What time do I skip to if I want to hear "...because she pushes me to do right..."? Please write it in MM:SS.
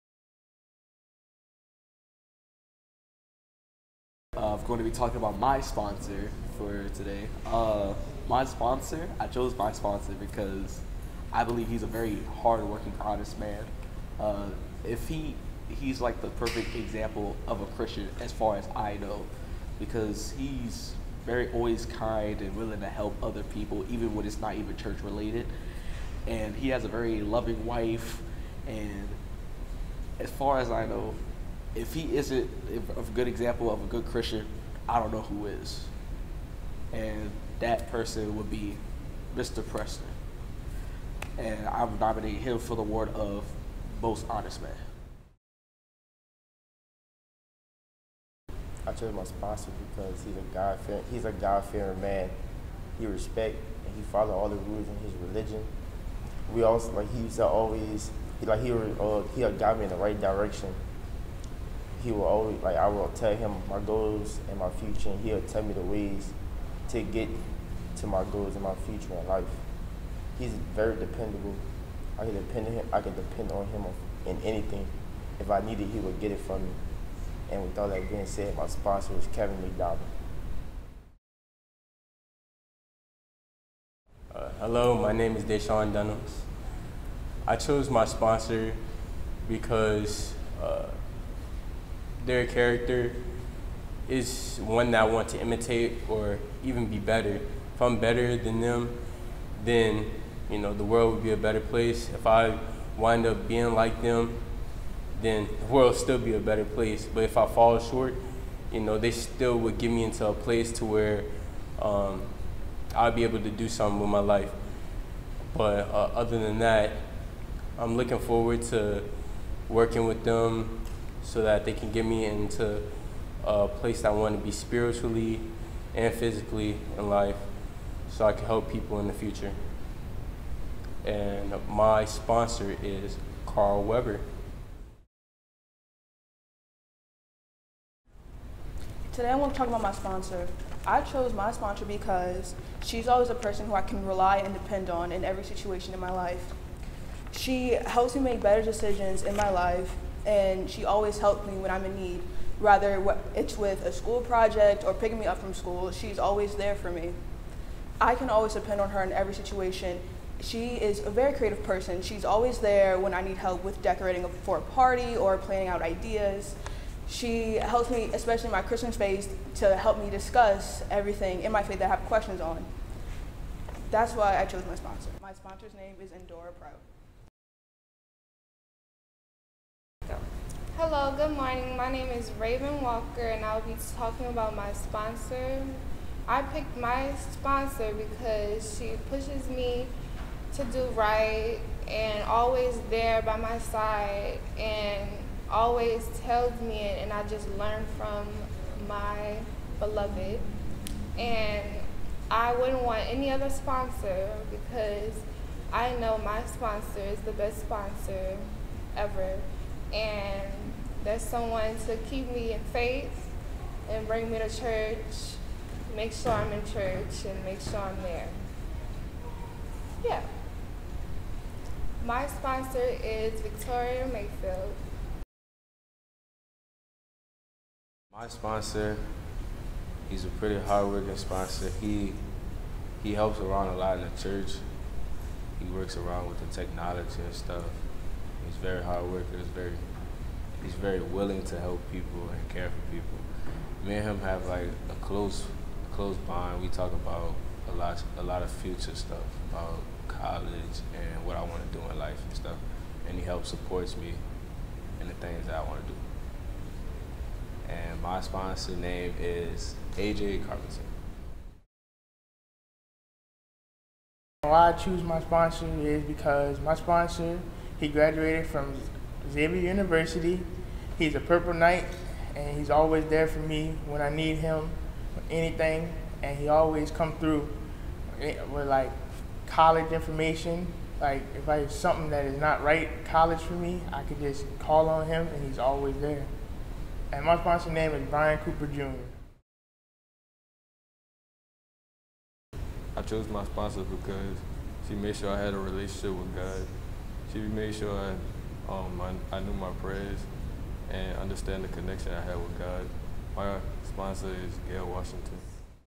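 03:07.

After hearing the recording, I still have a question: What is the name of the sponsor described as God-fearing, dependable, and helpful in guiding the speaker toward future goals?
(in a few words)
Kevin McDonald.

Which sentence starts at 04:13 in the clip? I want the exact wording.
And he helps supports me in the things that I want to do.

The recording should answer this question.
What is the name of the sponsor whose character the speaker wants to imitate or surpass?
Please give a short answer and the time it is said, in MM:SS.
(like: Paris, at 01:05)
Carl Weber, at 02:13.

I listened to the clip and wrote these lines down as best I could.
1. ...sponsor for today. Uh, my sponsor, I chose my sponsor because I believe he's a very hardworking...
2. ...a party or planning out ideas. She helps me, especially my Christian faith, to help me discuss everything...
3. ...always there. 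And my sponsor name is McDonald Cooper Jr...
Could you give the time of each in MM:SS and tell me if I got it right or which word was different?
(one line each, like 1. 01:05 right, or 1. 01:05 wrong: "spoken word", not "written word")
1. 00:05 right
2. 02:44 right
3. 04:45 wrong: "Brian", not "McDonald".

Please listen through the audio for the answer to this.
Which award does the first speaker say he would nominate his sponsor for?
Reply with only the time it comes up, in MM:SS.
00:44.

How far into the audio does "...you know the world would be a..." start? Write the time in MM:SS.
01:40.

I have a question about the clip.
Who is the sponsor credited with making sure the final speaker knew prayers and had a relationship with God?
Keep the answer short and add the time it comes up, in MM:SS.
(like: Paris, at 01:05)
Gail Washington, at 05:04.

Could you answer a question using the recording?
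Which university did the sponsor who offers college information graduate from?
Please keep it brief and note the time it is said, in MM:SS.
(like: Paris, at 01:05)
Xavier University, at 04:29.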